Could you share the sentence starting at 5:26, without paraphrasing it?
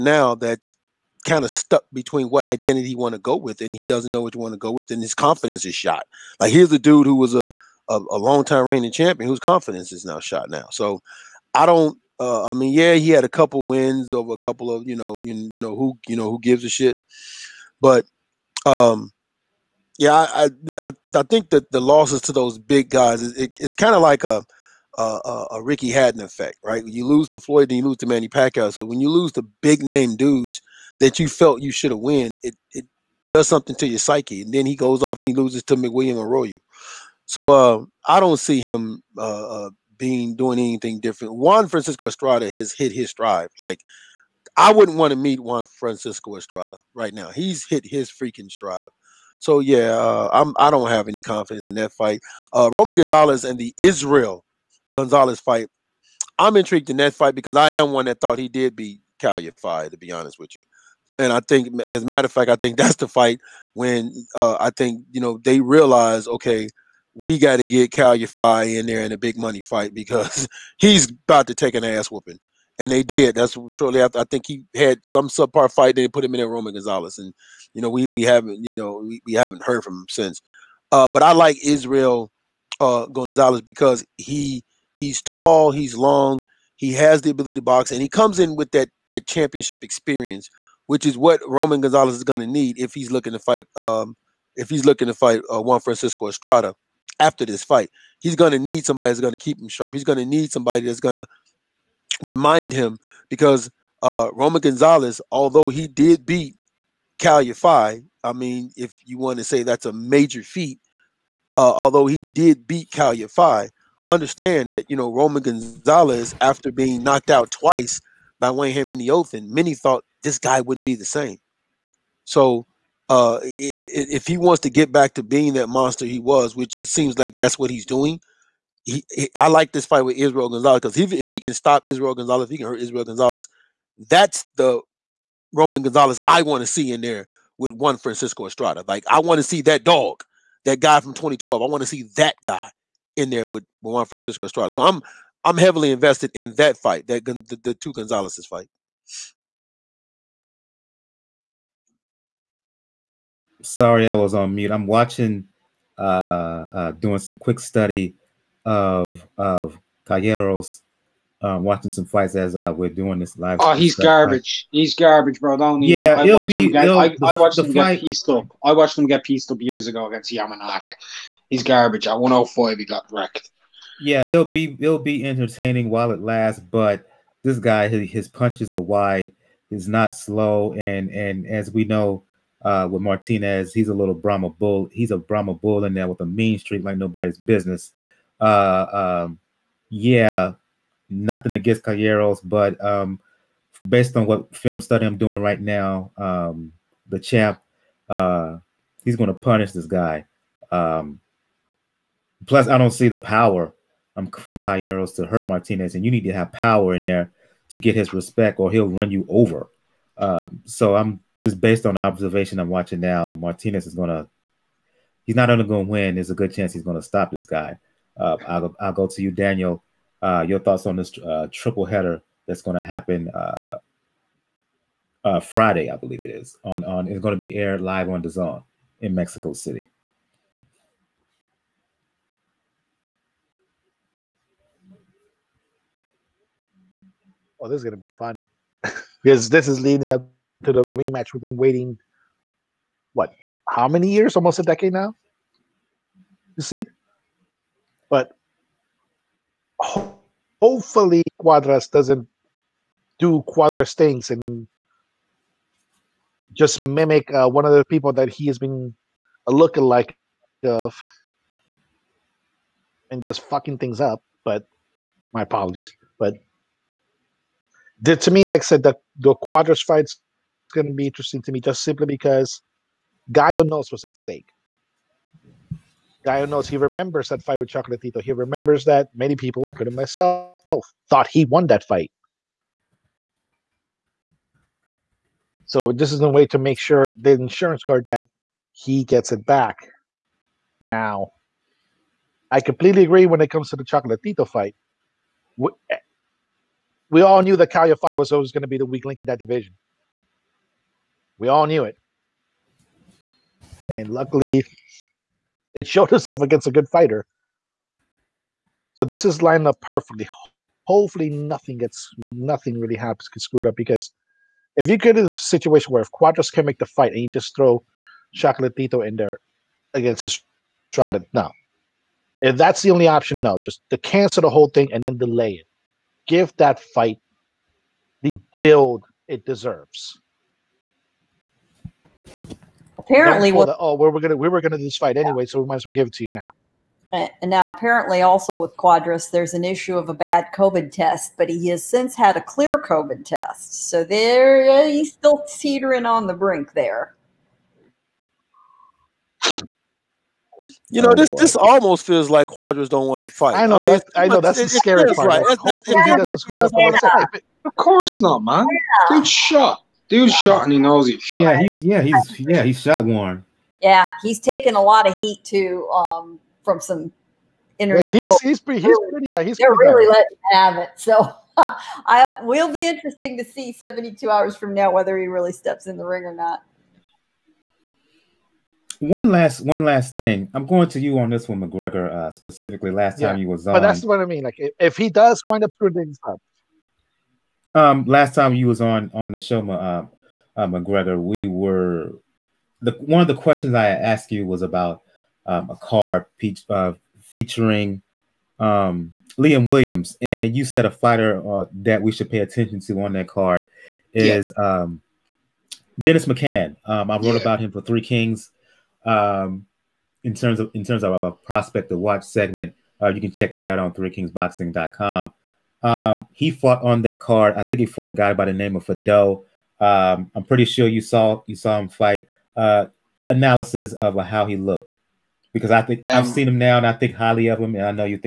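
Give that fight the build it deserves apparently, with, the, oh, we're gonna we were gonna do this fight anyway, yeah.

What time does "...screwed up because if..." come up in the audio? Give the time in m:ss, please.
5:13.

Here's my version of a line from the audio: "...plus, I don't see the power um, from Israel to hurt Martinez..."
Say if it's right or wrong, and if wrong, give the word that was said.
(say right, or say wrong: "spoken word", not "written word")
wrong: "Calleros", not "Israel".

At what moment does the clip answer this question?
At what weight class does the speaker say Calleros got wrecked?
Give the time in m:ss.
2:52.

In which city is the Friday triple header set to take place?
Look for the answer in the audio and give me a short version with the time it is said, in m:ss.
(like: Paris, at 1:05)
Mexico City, at 3:49.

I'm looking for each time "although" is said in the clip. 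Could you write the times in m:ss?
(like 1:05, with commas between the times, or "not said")
1:45, 1:51.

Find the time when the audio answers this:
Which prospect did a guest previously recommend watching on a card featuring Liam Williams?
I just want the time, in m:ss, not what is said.
6:45.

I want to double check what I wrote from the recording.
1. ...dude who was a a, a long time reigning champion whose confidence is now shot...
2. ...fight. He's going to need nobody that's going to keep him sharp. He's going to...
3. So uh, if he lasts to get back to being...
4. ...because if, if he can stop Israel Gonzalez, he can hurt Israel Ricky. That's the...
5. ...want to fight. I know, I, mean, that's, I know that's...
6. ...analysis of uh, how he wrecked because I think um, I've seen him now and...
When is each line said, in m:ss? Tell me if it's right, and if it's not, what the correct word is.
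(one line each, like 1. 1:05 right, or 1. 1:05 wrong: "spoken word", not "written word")
1. 0:06 right
2. 1:37 wrong: "somebody", not "nobody"
3. 2:02 wrong: "wants", not "lasts"
4. 2:10 wrong: "Gonzalez", not "Ricky"
5. 5:53 right
6. 7:03 wrong: "looked", not "wrecked".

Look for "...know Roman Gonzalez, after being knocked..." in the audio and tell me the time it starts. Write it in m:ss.
1:54.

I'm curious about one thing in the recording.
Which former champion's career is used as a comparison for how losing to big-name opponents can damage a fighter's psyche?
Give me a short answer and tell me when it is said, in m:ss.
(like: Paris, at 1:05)
Ricky Hatton, at 0:25.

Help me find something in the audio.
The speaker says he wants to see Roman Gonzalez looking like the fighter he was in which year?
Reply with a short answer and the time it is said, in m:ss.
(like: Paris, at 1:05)
2012, at 2:21.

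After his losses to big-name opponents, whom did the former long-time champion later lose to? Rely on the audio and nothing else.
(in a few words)
McWilliams Arroyo.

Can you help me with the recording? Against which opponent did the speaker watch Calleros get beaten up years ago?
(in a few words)
Yamanaka.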